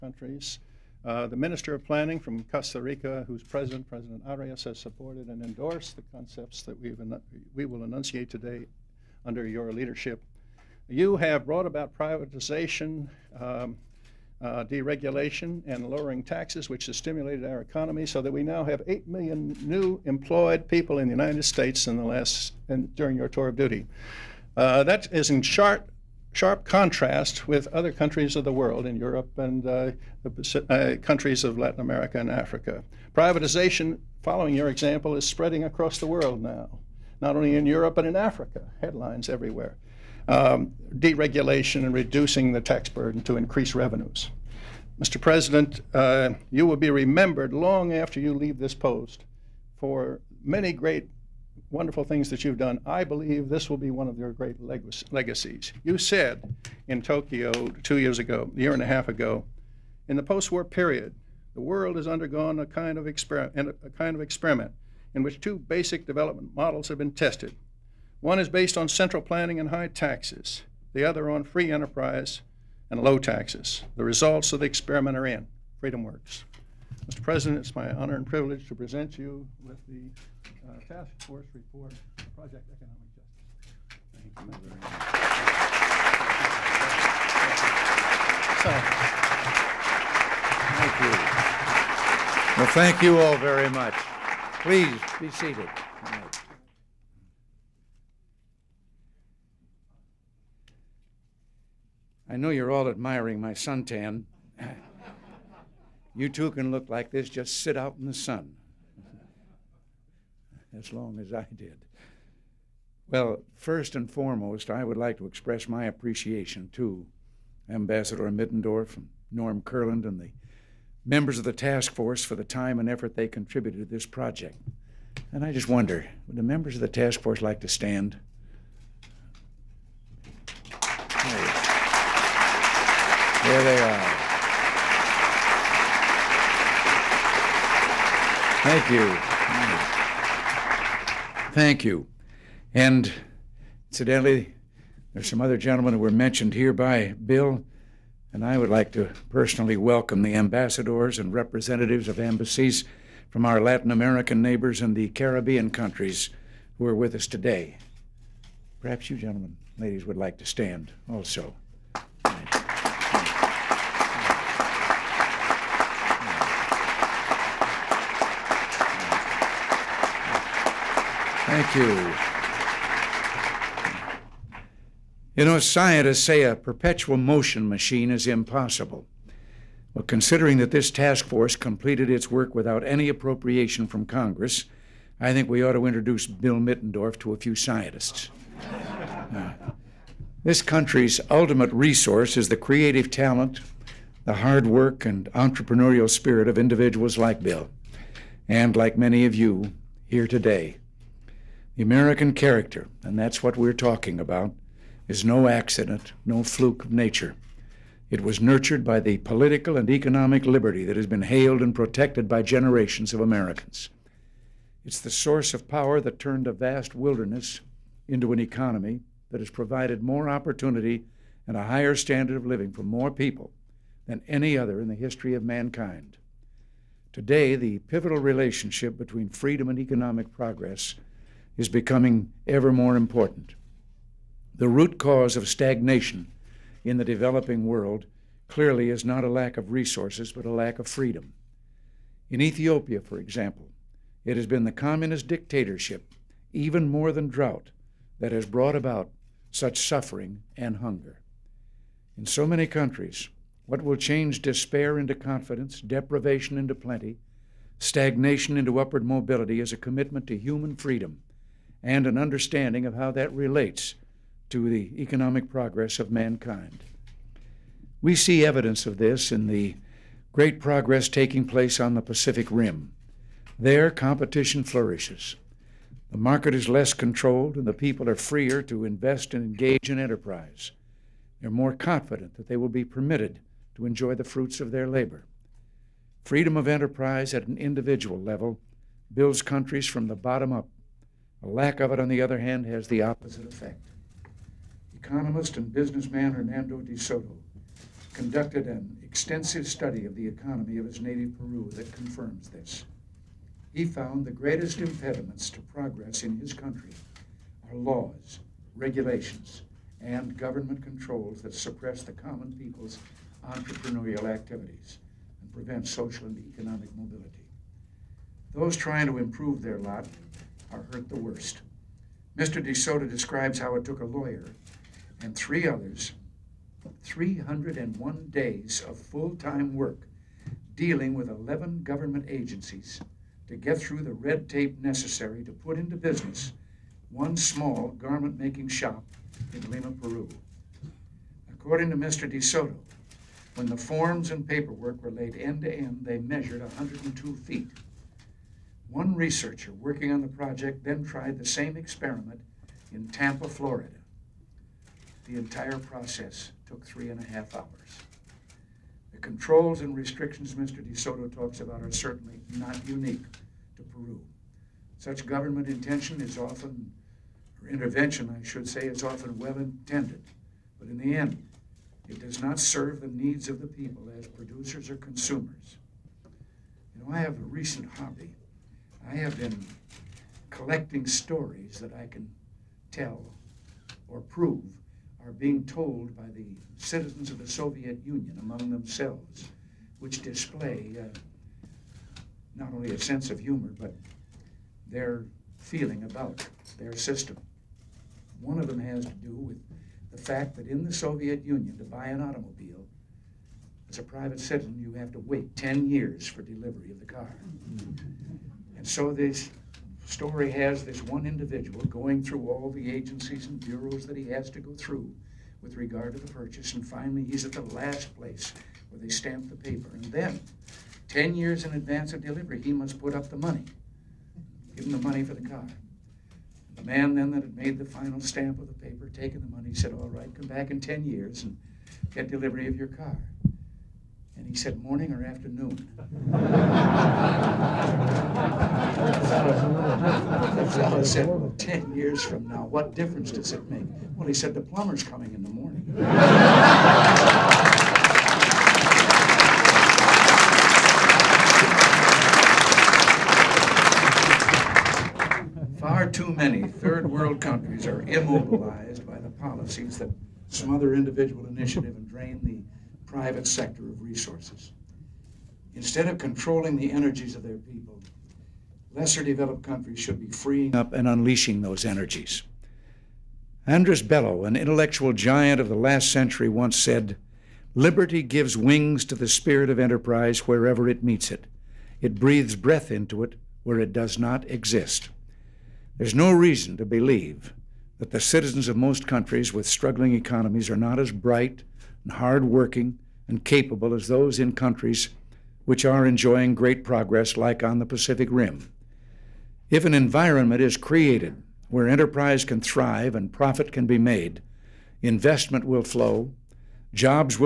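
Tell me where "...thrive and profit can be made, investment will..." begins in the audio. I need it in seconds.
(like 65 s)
502 s.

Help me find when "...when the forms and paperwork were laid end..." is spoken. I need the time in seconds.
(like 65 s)
343 s.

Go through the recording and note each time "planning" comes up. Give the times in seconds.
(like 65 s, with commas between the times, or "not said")
1 s, 69 s.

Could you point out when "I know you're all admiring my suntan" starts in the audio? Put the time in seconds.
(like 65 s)
102 s.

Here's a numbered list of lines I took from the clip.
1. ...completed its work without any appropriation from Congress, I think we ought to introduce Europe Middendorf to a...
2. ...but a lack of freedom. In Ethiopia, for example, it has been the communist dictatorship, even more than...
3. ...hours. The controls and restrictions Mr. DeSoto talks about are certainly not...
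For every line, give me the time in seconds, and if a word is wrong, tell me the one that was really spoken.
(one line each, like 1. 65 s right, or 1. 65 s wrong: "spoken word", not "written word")
1. 181 s wrong: "Bill", not "Europe"
2. 240 s right
3. 357 s right.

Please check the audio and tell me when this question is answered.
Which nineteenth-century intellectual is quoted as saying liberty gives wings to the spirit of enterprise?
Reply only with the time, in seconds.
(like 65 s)
473 s.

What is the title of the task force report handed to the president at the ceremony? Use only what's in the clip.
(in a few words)
Project Economic Justice.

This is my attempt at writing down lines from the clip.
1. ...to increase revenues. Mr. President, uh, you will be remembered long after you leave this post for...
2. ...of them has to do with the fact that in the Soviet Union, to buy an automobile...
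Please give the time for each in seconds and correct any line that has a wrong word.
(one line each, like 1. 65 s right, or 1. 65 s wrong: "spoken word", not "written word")
1. 43 s right
2. 398 s right.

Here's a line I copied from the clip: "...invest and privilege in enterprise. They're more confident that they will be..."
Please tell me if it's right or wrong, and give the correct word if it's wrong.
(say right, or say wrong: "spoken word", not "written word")
wrong: "engage", not "privilege".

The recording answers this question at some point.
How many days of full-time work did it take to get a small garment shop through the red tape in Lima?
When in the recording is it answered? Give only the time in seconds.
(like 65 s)
327 s.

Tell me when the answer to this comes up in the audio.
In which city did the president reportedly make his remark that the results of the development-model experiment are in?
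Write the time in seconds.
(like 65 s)
57 s.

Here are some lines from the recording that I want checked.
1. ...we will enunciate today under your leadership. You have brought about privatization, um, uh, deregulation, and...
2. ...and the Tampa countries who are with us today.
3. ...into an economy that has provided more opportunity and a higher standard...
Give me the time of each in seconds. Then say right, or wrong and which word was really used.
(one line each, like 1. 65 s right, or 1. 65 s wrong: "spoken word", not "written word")
1. 7 s right
2. 154 s wrong: "Caribbean", not "Tampa"
3. 218 s right.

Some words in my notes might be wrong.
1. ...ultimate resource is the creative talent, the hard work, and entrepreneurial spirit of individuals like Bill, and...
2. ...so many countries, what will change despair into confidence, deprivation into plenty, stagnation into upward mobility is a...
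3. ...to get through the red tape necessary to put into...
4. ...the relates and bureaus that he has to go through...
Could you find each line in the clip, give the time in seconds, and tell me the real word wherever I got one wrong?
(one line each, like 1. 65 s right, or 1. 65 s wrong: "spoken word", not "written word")
1. 191 s right
2. 252 s right
3. 333 s right
4. 412 s wrong: "agencies", not "relates".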